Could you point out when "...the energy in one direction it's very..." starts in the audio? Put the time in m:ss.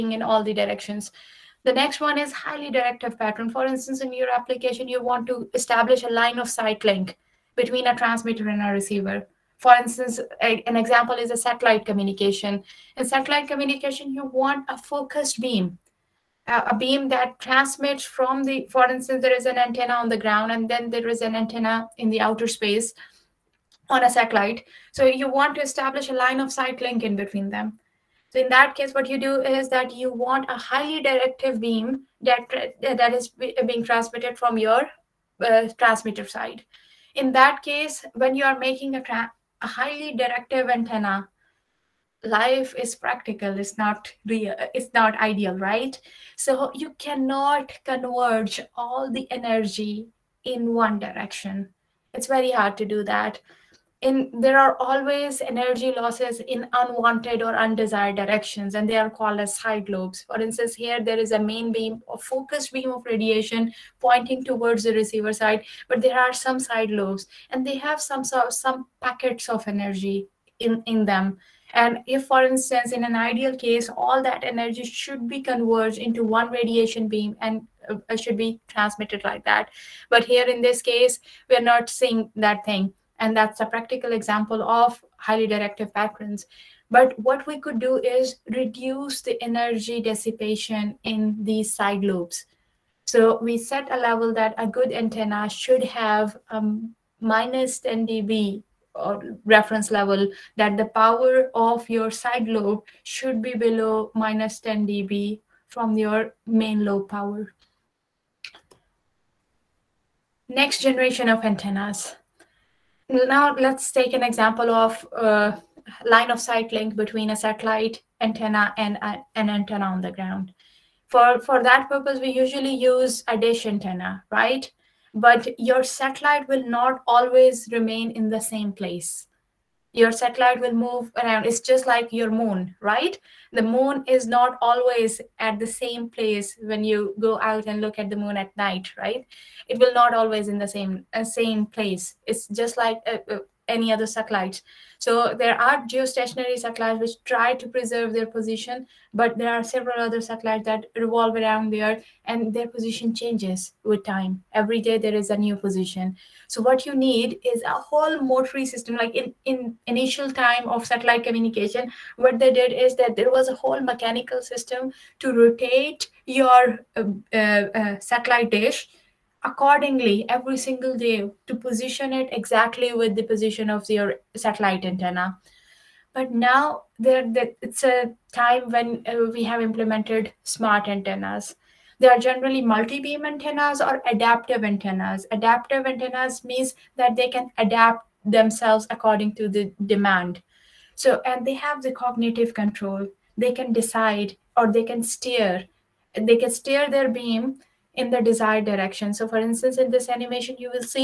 0:49.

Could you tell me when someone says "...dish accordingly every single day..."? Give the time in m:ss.
2:48.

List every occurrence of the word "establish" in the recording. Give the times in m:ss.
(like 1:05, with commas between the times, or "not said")
0:05, 0:25.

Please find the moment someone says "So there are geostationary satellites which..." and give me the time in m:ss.
2:25.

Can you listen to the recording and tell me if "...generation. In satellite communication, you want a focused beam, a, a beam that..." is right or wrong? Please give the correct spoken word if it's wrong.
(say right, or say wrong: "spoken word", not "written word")
wrong: "communication", not "generation".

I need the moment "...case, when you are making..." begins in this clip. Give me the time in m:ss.
0:37.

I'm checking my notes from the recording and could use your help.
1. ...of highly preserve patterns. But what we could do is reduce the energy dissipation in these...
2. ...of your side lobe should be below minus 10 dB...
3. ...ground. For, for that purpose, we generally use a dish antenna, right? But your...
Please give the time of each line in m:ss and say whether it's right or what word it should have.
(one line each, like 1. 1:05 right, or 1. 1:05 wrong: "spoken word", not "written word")
1. 1:24 wrong: "directive", not "preserve"
2. 1:41 right
3. 2:00 wrong: "usually", not "generally".